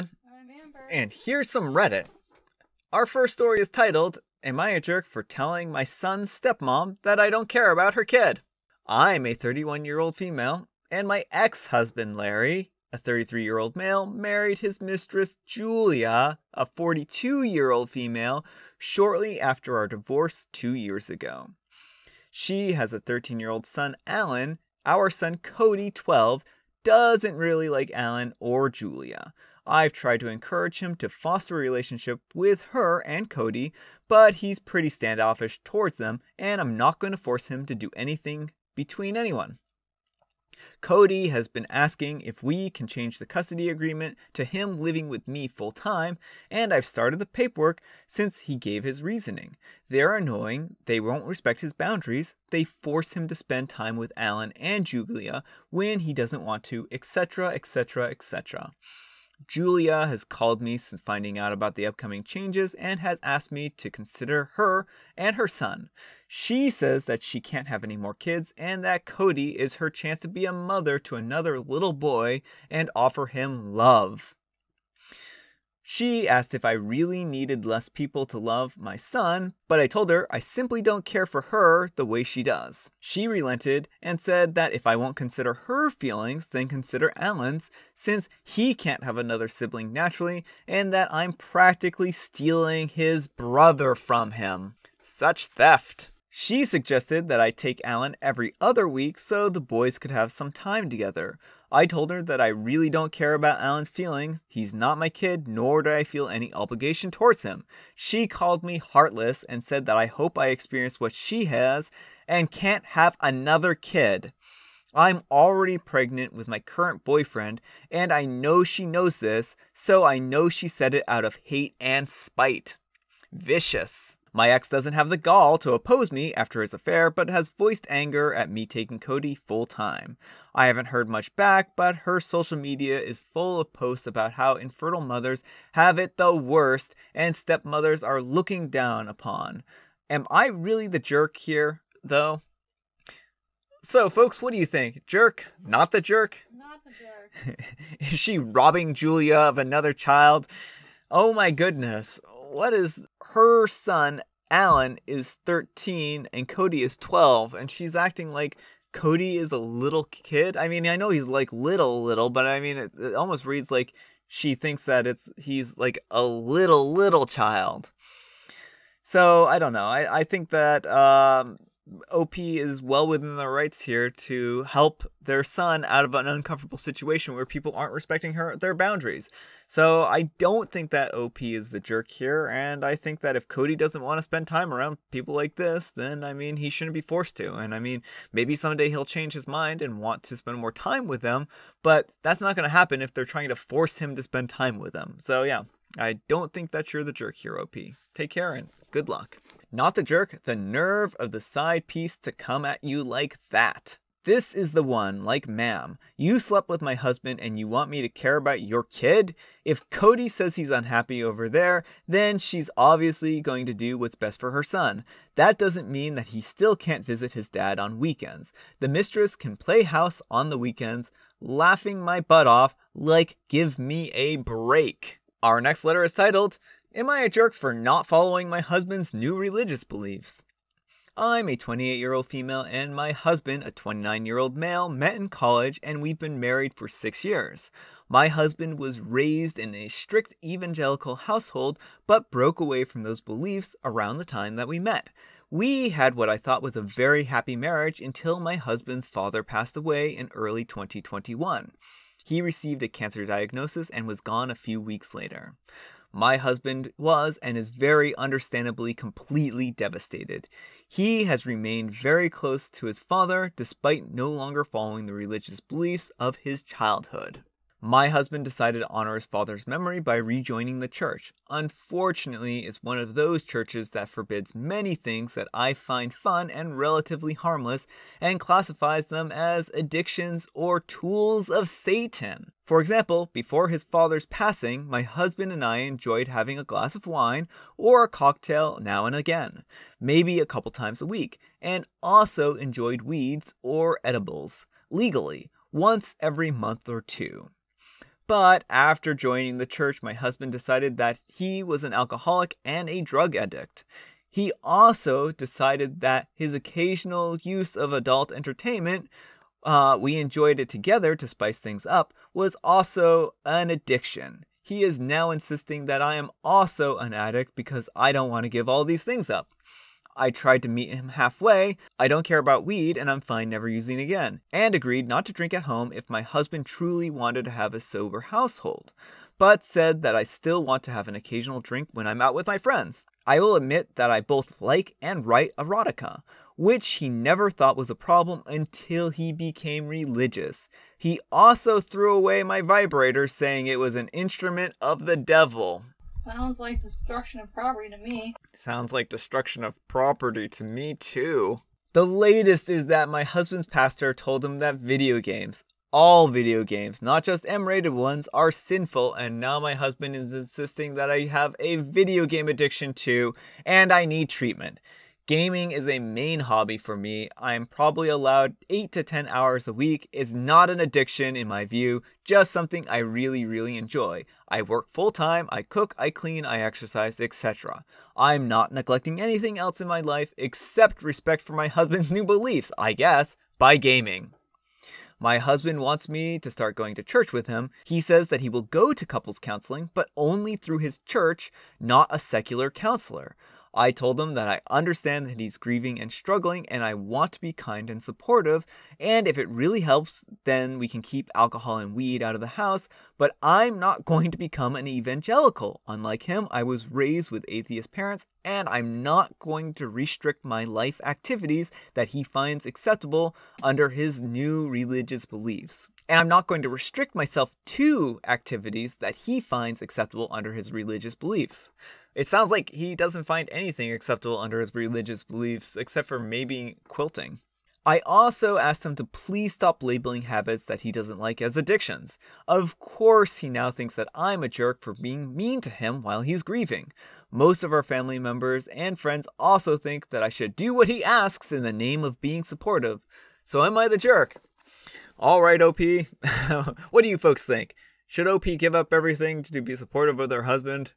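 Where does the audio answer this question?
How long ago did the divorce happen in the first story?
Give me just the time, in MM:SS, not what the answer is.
00:20.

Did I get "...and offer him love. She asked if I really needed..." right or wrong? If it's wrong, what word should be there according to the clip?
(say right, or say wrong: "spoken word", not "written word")
right.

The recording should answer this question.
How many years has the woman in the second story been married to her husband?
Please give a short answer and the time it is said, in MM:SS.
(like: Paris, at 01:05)
6 years, at 03:56.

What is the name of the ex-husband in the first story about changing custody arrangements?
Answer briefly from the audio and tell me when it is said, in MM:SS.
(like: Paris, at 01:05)
Larry, at 00:12.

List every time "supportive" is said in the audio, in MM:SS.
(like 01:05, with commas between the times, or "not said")
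06:38, 07:22, 07:29.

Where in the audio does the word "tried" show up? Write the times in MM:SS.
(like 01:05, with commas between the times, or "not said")
00:29, 05:20.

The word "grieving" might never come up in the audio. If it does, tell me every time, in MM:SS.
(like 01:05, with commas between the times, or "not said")
06:35, 07:16.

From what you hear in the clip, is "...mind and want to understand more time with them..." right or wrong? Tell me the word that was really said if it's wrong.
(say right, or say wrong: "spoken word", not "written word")
wrong: "spend", not "understand".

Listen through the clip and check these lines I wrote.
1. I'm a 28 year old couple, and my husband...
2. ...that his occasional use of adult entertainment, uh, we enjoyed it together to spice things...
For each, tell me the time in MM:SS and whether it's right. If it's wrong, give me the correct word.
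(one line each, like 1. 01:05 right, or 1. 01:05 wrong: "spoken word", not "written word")
1. 03:51 wrong: "female", not "couple"
2. 05:06 right.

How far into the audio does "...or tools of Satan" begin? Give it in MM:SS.
04:40.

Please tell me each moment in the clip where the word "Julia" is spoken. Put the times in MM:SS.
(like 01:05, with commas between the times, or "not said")
00:15, 00:28, 00:54, 00:59, 02:28.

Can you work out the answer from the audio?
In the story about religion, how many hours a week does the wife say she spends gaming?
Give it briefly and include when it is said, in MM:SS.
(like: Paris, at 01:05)
8 to 10, at 06:08.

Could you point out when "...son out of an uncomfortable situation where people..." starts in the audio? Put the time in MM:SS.
02:55.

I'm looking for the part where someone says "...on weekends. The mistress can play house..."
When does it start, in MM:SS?
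03:37.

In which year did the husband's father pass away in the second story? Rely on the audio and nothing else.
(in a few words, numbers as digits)
2021.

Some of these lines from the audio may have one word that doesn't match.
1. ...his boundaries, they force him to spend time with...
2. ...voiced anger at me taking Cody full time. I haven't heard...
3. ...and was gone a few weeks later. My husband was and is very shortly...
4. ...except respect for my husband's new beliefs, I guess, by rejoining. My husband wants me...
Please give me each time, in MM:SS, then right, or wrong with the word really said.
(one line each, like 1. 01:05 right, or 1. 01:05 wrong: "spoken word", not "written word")
1. 00:51 right
2. 02:07 right
3. 04:13 wrong: "understandably", not "shortly"
4. 06:20 wrong: "gaming", not "rejoining".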